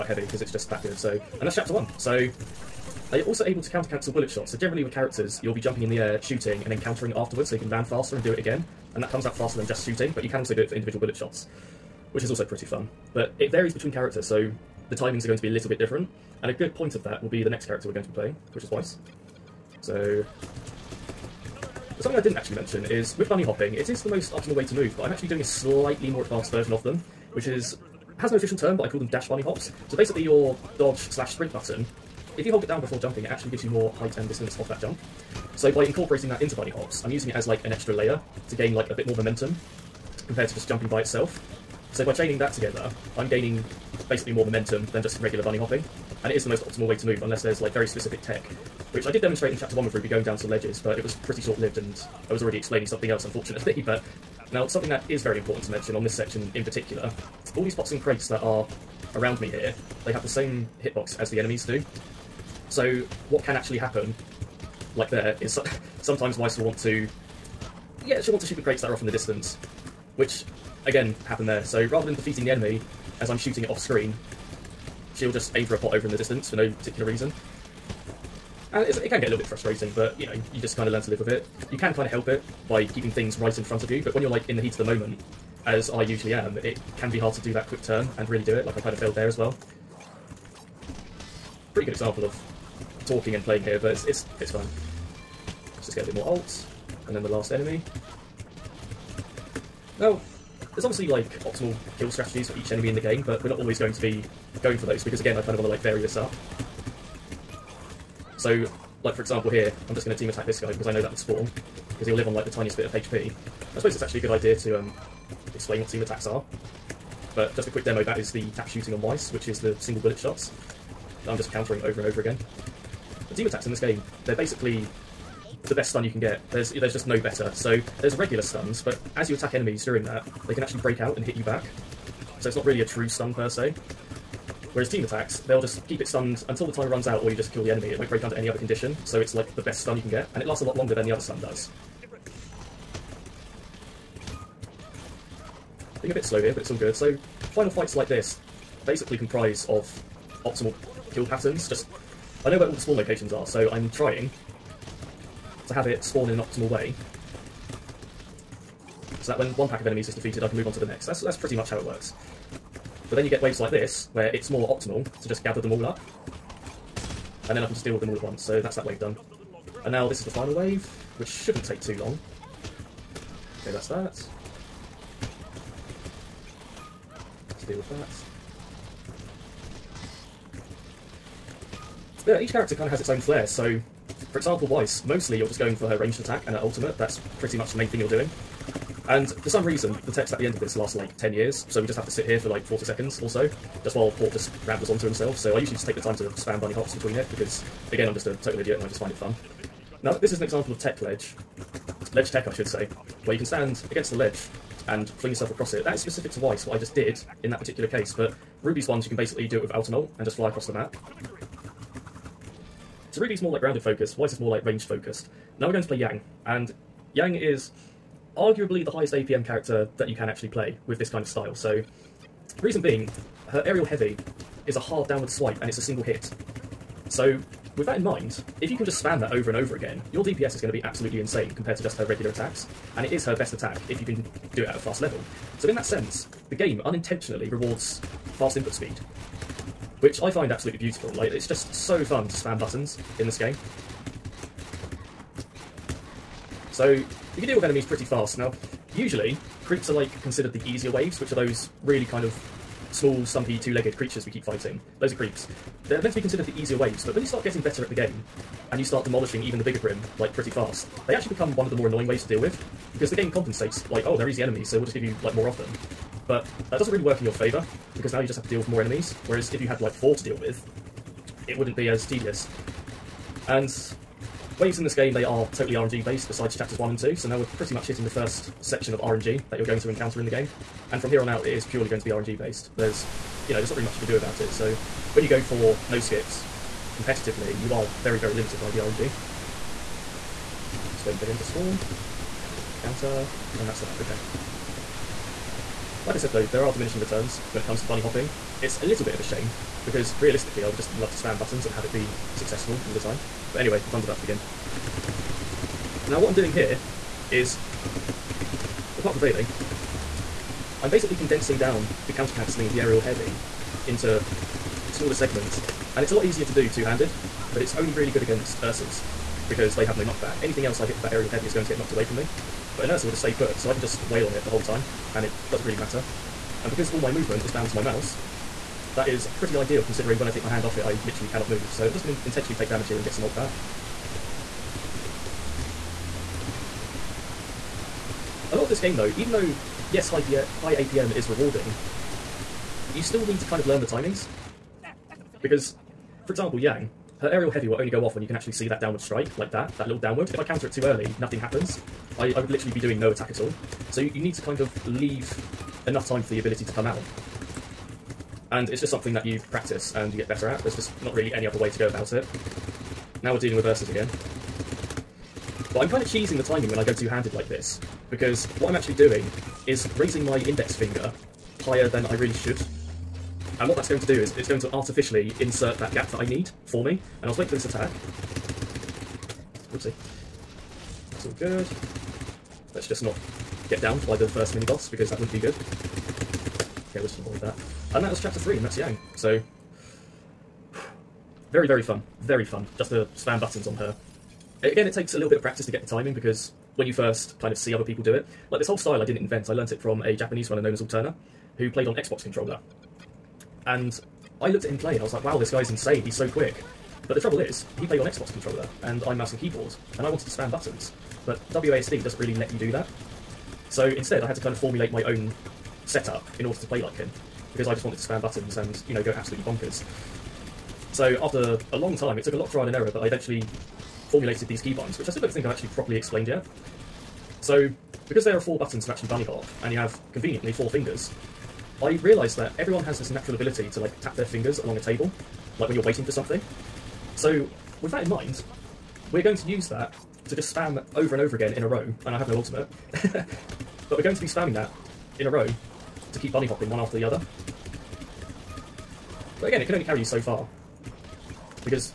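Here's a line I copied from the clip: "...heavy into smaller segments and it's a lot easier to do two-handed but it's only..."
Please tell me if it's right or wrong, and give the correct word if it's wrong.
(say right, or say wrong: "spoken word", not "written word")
right.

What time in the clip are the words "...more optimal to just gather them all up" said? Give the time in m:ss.
2:44.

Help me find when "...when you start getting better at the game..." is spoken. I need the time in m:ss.
4:17.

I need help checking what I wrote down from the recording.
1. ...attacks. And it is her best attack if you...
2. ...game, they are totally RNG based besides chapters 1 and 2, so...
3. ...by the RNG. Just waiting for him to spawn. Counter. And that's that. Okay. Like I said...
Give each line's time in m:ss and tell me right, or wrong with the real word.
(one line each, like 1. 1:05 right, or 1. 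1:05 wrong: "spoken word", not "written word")
1. 3:52 right
2. 4:34 right
3. 4:48 right.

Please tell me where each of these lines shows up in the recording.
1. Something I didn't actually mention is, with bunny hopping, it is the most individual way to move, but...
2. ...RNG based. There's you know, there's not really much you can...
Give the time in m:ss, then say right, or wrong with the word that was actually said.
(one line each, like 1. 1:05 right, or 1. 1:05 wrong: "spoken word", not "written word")
1. 0:22 wrong: "optimal", not "individual"
2. 4:42 right.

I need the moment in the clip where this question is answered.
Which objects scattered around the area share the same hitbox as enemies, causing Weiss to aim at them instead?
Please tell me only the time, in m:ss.
0:57.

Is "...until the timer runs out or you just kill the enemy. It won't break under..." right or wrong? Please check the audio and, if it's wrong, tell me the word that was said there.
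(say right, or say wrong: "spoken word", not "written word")
right.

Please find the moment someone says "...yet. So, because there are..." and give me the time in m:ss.
7:06.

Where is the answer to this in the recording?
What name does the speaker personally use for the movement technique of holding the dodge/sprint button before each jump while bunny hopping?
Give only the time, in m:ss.
0:29.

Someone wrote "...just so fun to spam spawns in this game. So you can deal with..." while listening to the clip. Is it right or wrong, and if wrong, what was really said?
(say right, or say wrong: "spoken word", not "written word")
wrong: "buttons", not "spawns".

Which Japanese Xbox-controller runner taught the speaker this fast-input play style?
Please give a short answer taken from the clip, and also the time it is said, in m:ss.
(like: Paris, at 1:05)
Alterna, at 6:40.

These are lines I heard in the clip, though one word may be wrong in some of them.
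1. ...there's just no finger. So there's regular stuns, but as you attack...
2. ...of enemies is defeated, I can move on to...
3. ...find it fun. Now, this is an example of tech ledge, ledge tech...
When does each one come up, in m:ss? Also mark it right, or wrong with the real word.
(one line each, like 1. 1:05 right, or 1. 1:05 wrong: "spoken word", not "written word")
1. 2:06 wrong: "better", not "finger"
2. 2:39 right
3. 3:19 right.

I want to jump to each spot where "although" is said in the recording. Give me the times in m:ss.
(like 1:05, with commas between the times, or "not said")
not said.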